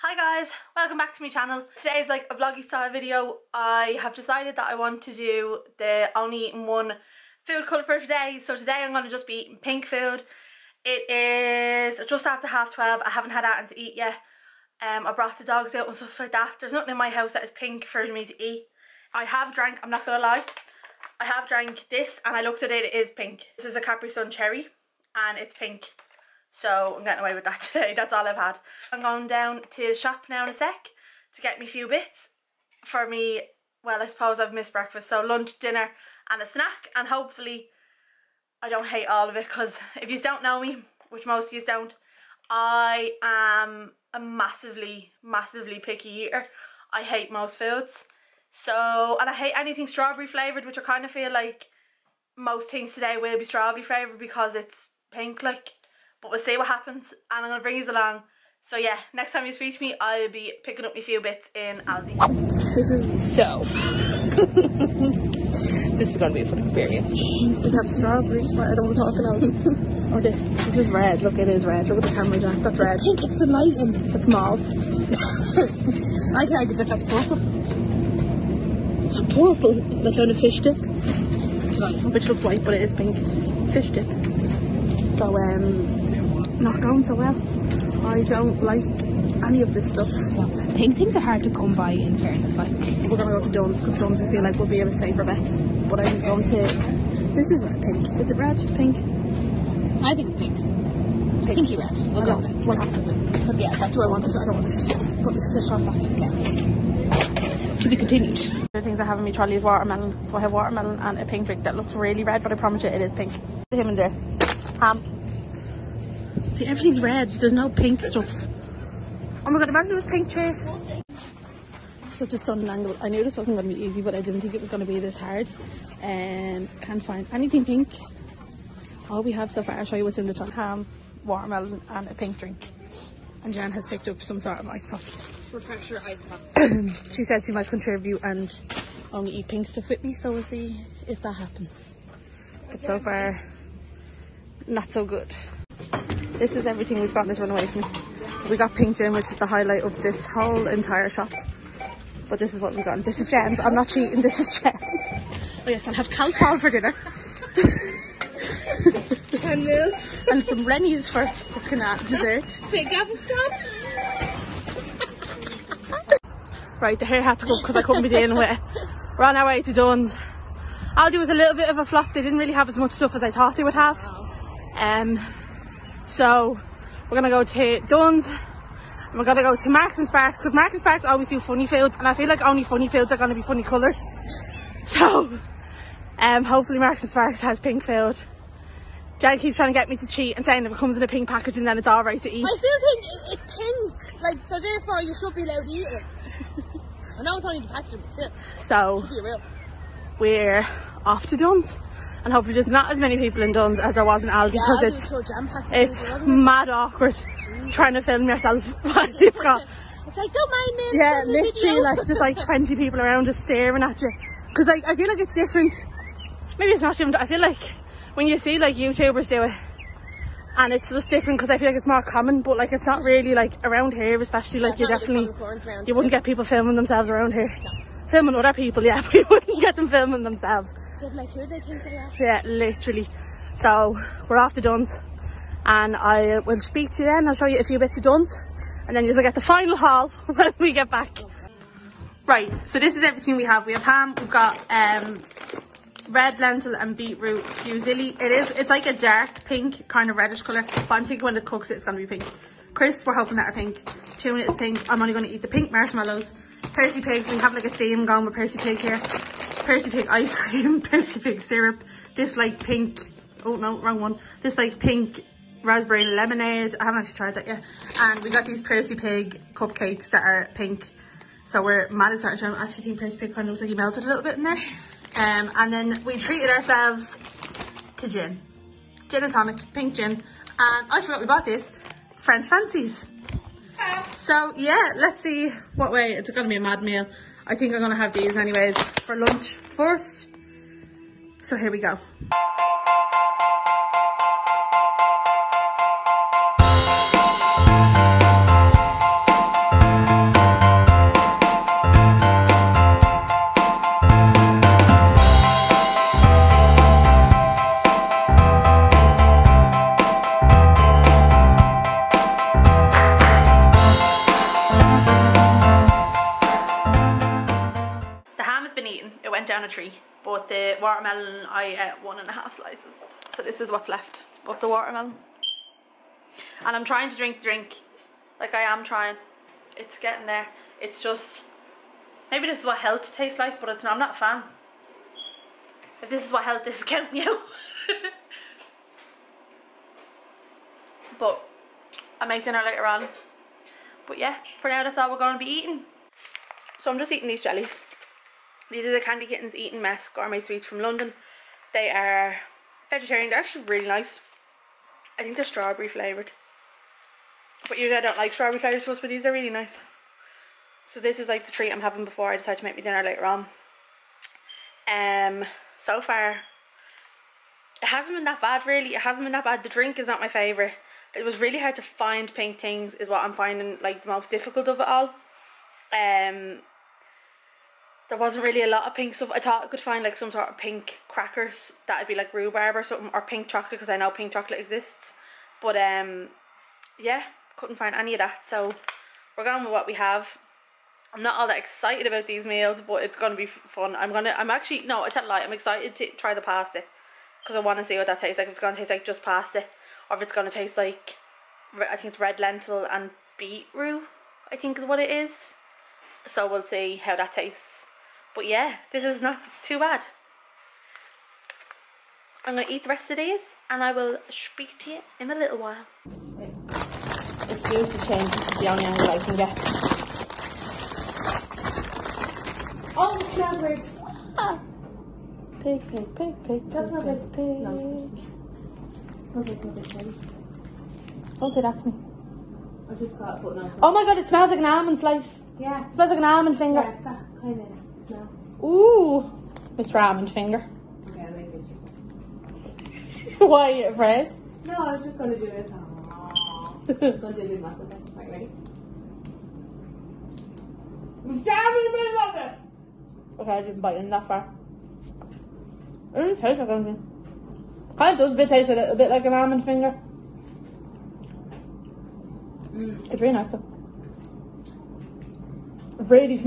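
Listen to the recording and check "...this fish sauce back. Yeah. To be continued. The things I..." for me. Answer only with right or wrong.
right.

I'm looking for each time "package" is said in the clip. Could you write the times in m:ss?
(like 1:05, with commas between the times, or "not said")
3:11, 3:17.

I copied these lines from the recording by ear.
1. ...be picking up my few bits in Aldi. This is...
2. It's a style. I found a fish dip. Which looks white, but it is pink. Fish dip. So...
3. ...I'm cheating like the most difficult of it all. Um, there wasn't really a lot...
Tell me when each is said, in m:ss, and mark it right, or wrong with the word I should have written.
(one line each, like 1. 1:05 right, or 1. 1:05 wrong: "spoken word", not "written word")
1. 1:00 right
2. 1:19 wrong: "purple", not "style"
3. 6:13 wrong: "finding", not "cheating".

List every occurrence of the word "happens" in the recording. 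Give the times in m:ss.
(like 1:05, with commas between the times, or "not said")
0:56, 2:21.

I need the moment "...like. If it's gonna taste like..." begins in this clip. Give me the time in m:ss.
6:38.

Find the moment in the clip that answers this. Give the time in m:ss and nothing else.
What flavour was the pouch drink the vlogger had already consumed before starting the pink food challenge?
0:23.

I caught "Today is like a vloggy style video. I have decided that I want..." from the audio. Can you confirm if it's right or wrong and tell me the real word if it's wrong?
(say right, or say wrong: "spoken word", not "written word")
right.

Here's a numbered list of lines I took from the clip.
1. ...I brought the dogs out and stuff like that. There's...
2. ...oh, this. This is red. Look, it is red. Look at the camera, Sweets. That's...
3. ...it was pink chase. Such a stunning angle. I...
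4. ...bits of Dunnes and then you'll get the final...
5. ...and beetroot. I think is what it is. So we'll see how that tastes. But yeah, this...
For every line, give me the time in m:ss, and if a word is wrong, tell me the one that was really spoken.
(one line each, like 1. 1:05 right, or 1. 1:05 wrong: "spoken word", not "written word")
1. 0:15 right
2. 1:10 wrong: "Jack", not "Sweets"
3. 1:59 right
4. 3:57 right
5. 6:42 right.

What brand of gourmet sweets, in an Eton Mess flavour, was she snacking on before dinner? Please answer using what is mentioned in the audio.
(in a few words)
Candy Kittens.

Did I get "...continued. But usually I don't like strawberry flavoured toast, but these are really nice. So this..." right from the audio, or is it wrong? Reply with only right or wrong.
wrong.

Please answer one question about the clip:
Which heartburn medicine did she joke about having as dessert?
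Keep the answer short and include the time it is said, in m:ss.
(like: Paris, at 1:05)
Rennies, at 2:40.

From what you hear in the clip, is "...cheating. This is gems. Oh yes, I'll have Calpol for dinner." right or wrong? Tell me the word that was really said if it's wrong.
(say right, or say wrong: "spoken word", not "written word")
right.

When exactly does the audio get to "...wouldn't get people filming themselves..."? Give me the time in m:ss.
3:45.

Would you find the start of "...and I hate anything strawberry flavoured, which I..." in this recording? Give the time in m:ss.
0:49.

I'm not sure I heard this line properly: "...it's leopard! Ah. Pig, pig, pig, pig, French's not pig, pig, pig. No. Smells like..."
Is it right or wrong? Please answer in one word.
wrong.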